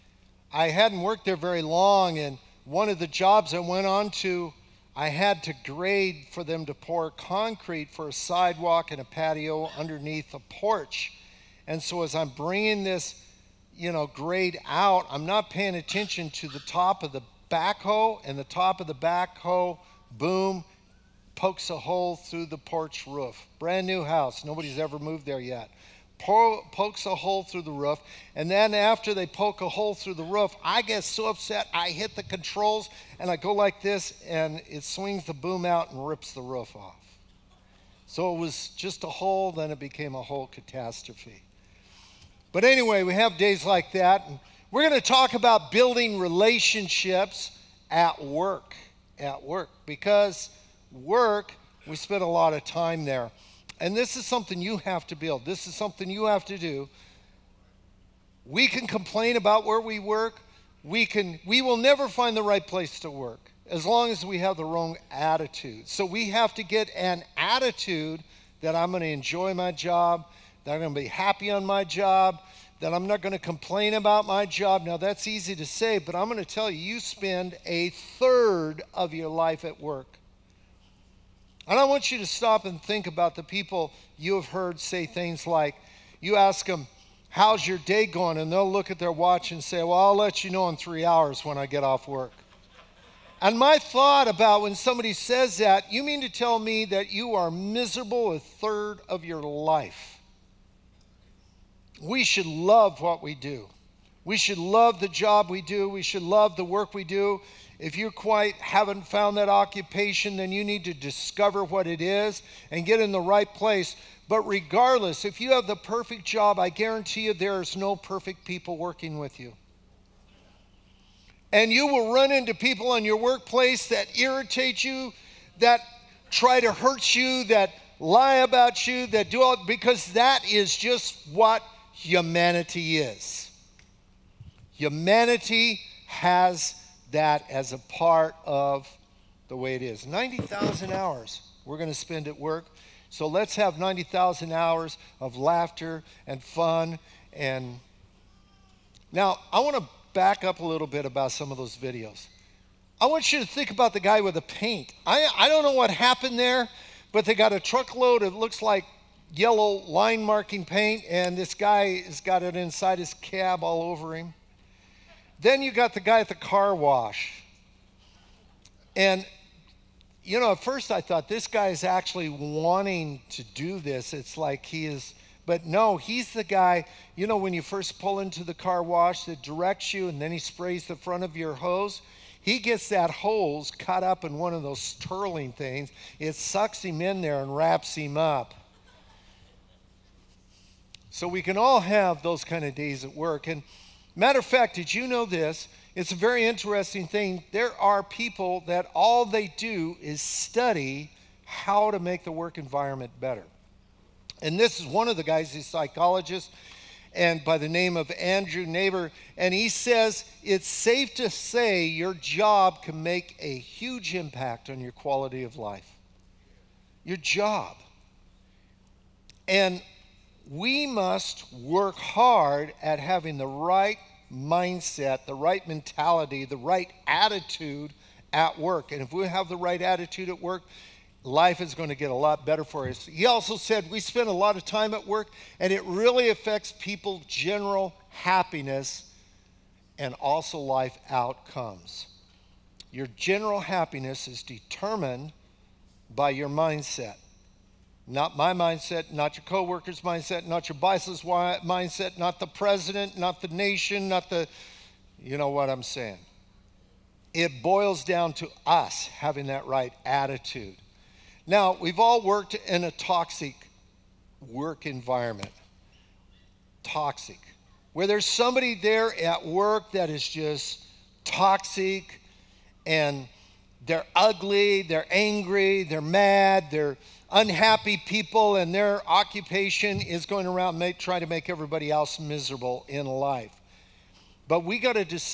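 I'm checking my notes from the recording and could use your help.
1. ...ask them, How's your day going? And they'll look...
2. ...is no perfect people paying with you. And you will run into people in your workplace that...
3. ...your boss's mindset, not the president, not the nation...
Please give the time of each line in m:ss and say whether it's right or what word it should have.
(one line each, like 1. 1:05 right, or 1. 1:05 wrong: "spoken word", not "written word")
1. 1:26 right
2. 1:57 wrong: "working", not "paying"
3. 4:10 right.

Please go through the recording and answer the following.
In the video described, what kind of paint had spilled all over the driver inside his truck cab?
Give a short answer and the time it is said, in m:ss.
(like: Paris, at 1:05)
yellow line marking paint, at 2:39.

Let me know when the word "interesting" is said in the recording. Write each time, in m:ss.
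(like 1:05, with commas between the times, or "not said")
3:16.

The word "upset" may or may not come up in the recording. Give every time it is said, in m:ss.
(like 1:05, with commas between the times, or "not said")
0:31.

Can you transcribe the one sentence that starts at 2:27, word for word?
And now I want to back up a little bit about some of those videos.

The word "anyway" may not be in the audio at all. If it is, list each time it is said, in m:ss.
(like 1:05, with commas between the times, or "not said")
0:42.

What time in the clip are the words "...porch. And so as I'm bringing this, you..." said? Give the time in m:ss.
0:10.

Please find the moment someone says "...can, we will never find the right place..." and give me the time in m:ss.
1:01.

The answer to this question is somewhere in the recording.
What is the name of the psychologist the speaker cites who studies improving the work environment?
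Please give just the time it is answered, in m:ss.
3:28.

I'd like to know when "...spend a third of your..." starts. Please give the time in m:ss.
1:16.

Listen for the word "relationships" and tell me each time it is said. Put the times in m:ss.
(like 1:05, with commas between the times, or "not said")
0:46.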